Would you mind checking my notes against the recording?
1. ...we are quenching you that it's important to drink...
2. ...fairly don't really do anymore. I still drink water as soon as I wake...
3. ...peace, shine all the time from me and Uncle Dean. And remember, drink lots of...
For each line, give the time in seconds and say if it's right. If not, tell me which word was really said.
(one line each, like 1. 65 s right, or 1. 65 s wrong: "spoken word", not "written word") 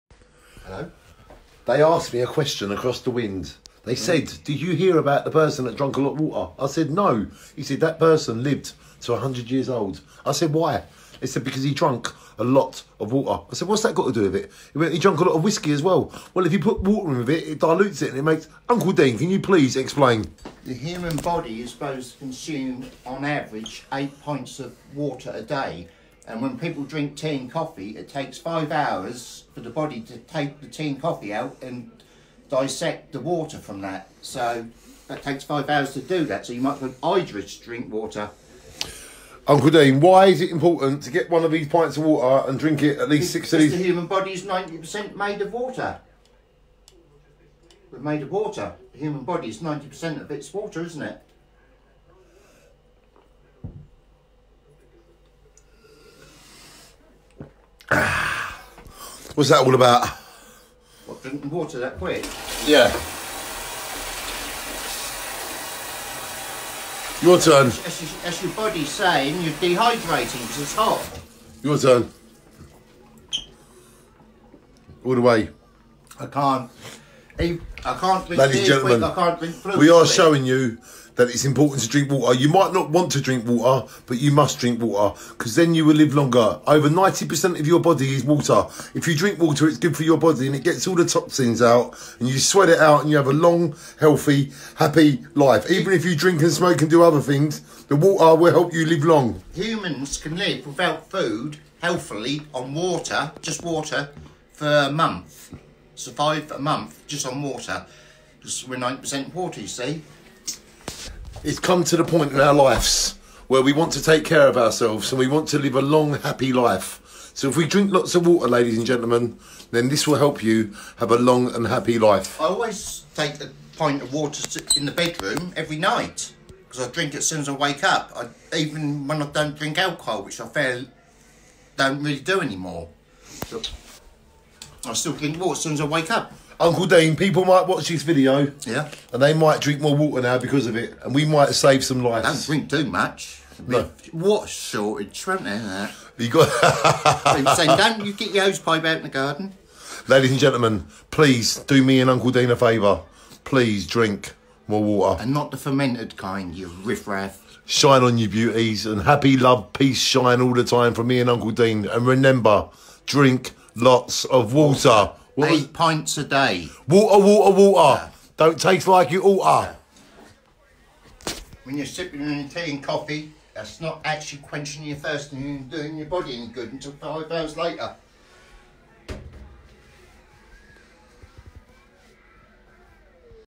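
1. 79 s wrong: "showing", not "quenching"
2. 130 s right
3. 159 s right.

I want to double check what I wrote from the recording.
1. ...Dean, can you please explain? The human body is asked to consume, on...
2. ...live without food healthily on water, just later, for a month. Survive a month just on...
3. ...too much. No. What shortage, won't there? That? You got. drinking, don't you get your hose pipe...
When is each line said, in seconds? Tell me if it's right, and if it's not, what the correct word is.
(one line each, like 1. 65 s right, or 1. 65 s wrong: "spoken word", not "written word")
1. 18 s wrong: "supposed", not "asked"
2. 100 s wrong: "water", not "later"
3. 142 s wrong: "saying", not "drinking".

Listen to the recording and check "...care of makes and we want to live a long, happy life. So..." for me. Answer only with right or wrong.
wrong.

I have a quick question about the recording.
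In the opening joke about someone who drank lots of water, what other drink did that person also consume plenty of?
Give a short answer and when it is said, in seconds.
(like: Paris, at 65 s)
Whiskey, at 15 s.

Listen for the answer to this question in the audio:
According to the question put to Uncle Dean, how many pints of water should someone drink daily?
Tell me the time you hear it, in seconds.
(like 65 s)
43 s.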